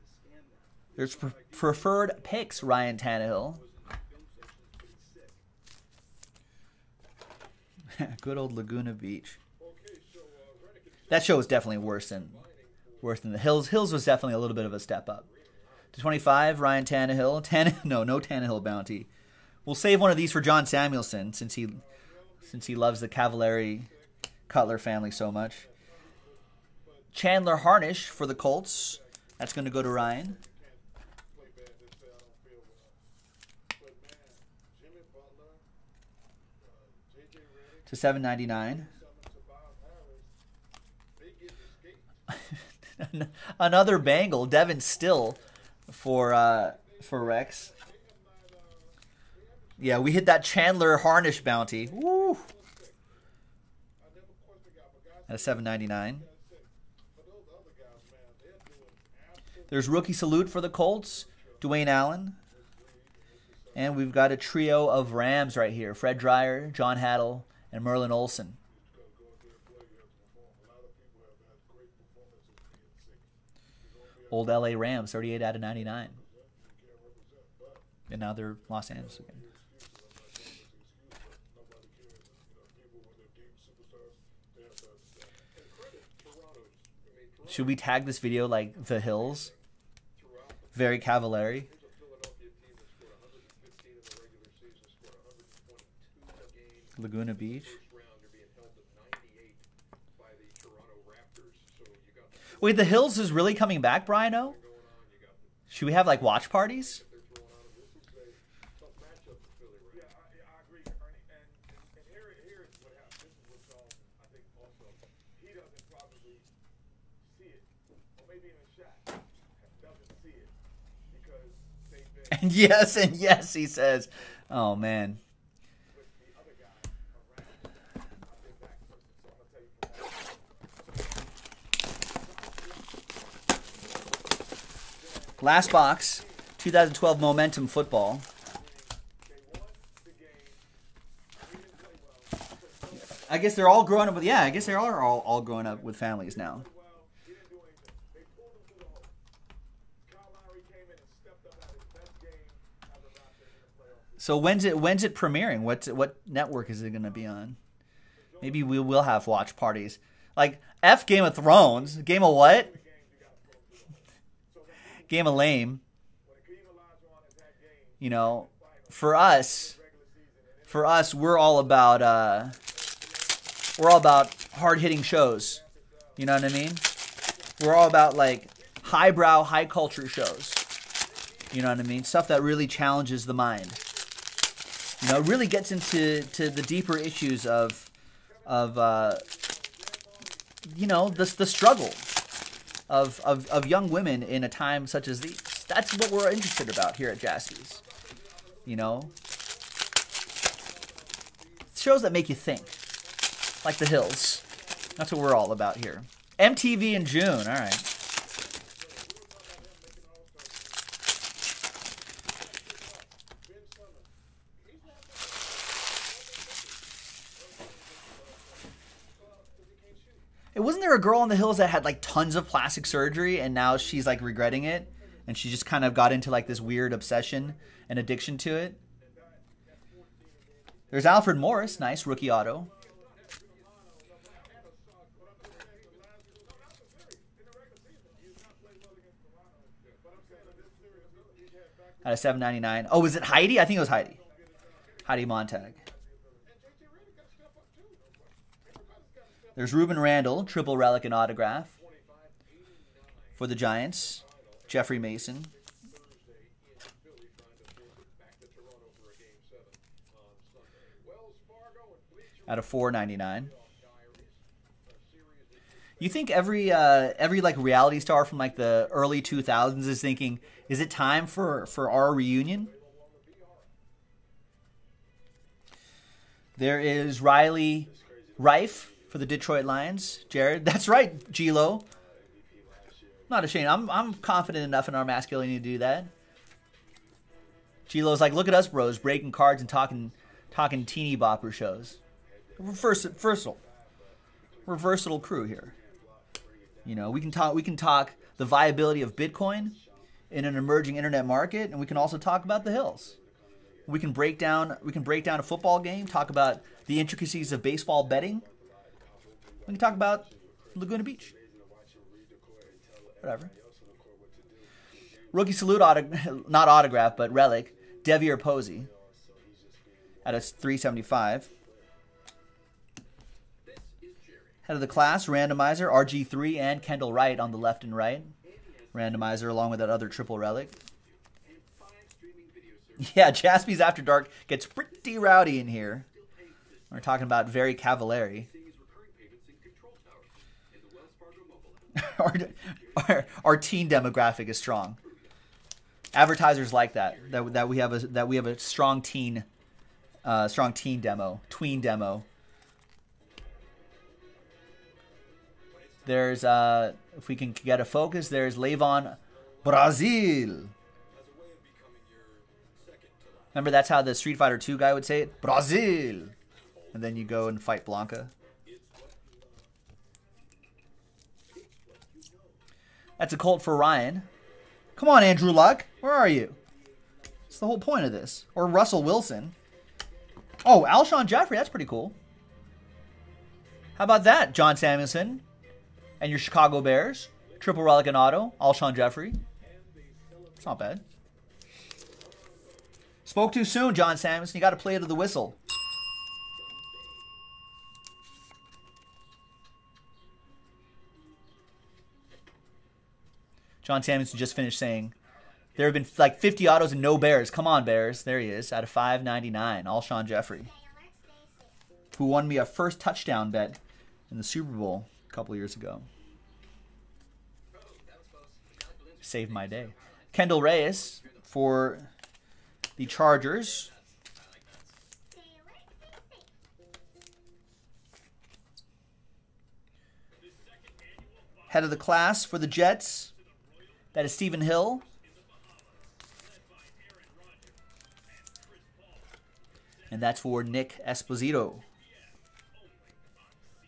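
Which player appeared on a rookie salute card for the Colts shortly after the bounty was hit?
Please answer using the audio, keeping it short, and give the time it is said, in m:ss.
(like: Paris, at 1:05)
Dwayne Allen, at 1:01.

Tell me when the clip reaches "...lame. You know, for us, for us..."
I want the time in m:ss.
2:45.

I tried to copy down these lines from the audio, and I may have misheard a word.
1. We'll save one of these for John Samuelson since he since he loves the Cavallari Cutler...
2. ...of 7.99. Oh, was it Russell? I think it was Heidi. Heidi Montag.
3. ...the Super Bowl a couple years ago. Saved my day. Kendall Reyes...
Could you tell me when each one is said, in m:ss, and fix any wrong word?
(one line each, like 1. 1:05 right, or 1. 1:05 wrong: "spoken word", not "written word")
1. 0:19 right
2. 4:02 wrong: "Heidi", not "Russell"
3. 6:54 right.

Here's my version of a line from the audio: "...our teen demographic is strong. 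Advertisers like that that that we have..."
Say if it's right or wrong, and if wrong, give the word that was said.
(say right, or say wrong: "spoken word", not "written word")
right.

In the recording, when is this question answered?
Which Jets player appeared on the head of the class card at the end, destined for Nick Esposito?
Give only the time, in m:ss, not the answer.
7:14.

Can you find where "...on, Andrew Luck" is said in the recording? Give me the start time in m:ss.
6:15.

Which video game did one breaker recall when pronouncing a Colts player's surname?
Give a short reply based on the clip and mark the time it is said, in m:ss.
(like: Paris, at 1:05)
Street Fighter 2, at 6:04.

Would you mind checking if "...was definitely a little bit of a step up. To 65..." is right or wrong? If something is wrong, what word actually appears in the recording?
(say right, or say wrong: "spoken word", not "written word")
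wrong: "25", not "65".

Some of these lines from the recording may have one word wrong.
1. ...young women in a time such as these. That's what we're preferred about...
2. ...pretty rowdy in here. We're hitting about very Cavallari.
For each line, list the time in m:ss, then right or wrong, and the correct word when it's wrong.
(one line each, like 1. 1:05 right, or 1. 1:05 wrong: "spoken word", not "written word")
1. 3:13 wrong: "interested", not "preferred"
2. 5:34 wrong: "talking", not "hitting".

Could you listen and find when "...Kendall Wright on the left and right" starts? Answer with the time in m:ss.
5:26.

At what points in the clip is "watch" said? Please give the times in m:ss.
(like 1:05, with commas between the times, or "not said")
1:46, 2:39.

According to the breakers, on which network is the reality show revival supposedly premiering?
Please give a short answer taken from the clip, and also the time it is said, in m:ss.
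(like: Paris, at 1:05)
MTV, at 3:26.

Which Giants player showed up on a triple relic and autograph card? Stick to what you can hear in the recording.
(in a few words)
Rueben Randle.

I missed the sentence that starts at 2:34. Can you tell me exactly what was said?
So when's it when's it premiering?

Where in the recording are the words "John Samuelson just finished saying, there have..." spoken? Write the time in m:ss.
6:43.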